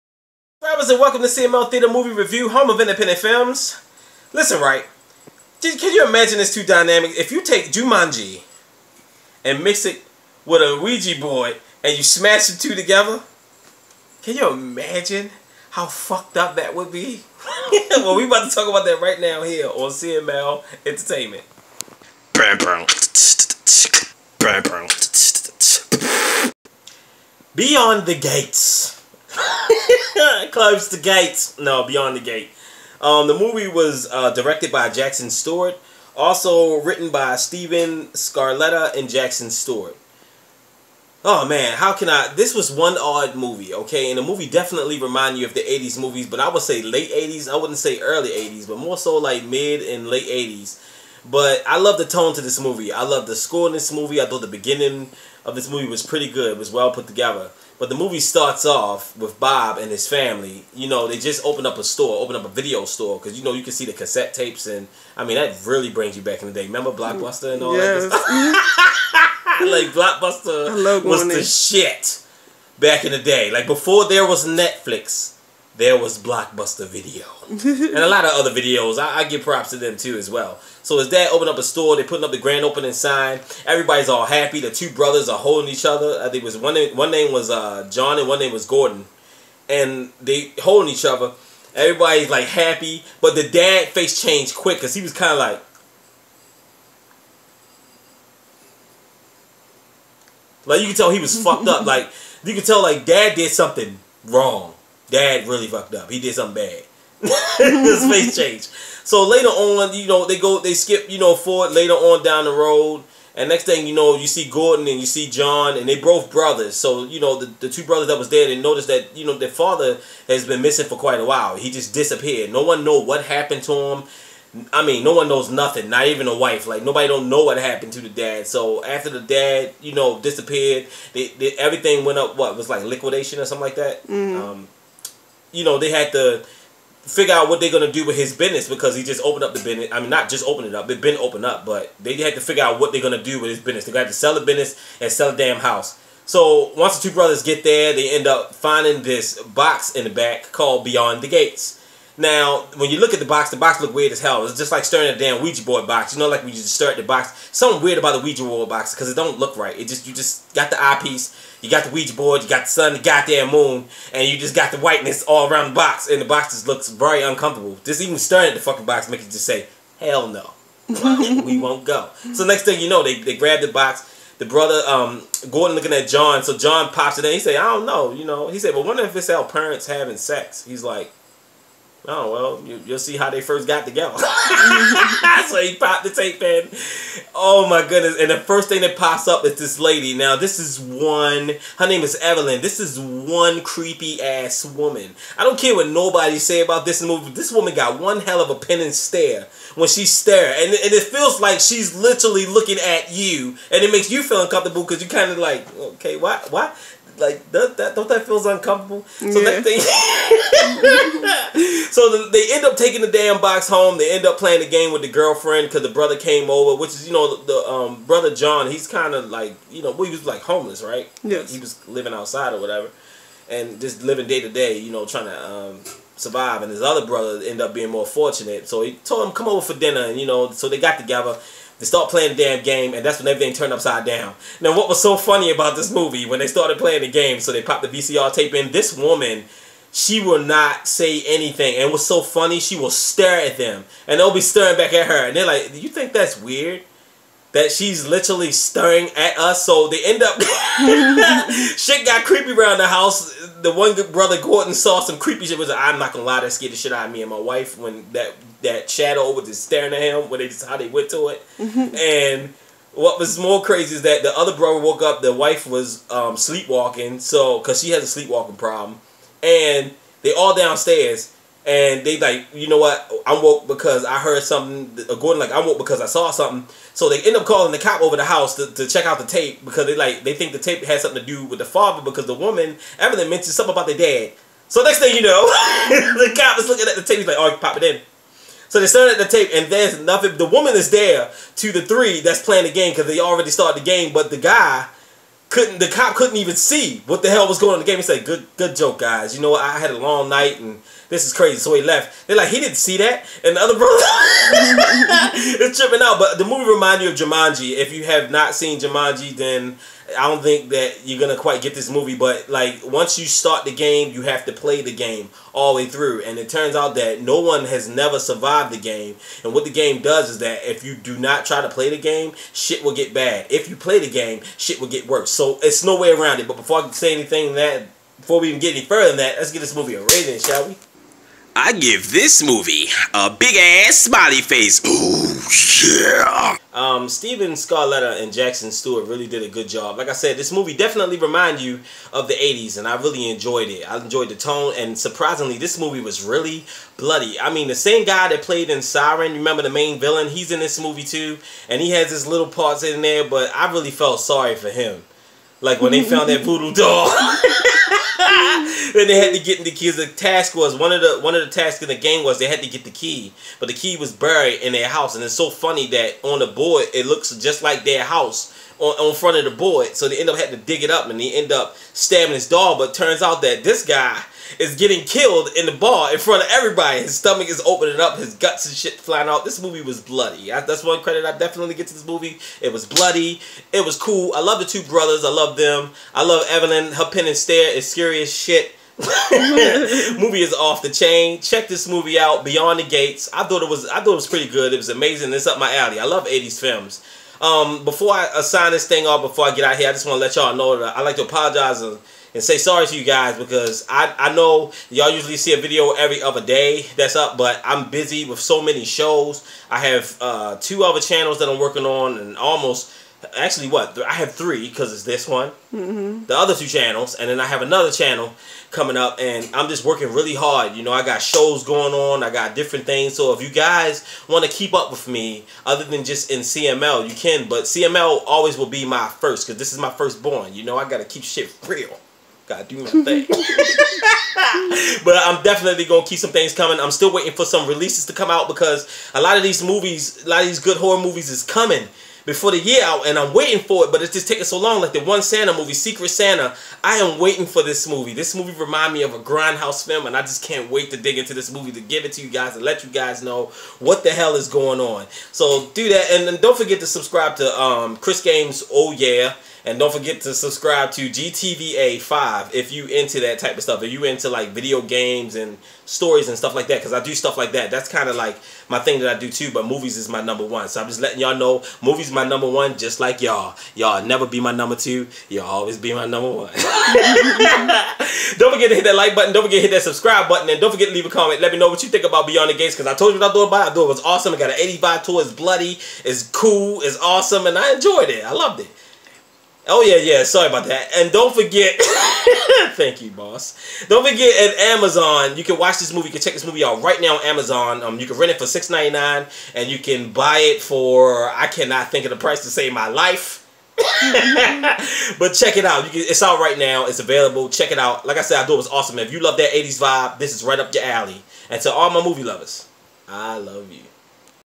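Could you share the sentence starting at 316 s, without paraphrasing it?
And it turns out that no one has never survived the game.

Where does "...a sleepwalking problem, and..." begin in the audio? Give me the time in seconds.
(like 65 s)
268 s.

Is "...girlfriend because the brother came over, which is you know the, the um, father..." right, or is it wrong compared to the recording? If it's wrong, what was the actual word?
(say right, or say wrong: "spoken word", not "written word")
wrong: "brother", not "father".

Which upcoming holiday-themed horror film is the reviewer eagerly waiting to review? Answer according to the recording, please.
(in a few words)
Secret Santa.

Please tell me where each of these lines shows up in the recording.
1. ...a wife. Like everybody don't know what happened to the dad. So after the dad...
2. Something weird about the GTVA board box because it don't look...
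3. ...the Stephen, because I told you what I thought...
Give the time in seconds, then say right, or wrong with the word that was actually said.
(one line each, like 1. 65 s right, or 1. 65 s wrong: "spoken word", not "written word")
1. 126 s wrong: "nobody", not "everybody"
2. 157 s wrong: "Ouija", not "GTVA"
3. 482 s wrong: "Gates", not "Stephen".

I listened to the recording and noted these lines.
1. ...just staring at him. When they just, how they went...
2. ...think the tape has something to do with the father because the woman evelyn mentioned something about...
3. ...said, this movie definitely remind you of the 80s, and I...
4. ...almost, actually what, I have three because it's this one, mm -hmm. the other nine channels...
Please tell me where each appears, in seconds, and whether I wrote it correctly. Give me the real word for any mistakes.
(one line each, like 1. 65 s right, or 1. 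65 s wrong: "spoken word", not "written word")
1. 259 s right
2. 280 s right
3. 340 s right
4. 412 s wrong: "two", not "nine".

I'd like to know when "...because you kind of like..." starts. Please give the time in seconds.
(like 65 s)
204 s.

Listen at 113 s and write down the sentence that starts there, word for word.
And next thing you know, you see Gordon and you see John, and they both brothers.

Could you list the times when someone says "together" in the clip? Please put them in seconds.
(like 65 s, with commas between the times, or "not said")
12 s, 57 s, 183 s, 230 s.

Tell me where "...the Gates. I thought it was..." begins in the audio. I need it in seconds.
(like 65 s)
392 s.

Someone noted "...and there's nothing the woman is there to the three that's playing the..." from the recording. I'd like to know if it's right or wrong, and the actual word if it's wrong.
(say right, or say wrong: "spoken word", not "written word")
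right.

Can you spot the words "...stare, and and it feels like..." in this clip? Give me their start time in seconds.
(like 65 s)
200 s.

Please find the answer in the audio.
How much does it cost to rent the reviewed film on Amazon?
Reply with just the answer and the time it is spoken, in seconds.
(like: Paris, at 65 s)
$6.99, at 498 s.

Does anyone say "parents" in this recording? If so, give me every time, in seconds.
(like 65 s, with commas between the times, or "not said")
179 s.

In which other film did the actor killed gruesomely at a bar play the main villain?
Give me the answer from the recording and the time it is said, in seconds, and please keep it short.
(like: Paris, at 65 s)
Siren, at 348 s.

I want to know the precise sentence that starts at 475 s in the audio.
Y'all always be my number one.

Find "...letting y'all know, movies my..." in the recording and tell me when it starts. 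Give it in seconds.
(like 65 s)
470 s.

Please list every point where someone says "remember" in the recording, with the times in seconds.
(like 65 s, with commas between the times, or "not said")
66 s, 349 s.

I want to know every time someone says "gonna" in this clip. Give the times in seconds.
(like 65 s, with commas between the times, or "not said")
137 s, 143 s, 311 s, 435 s.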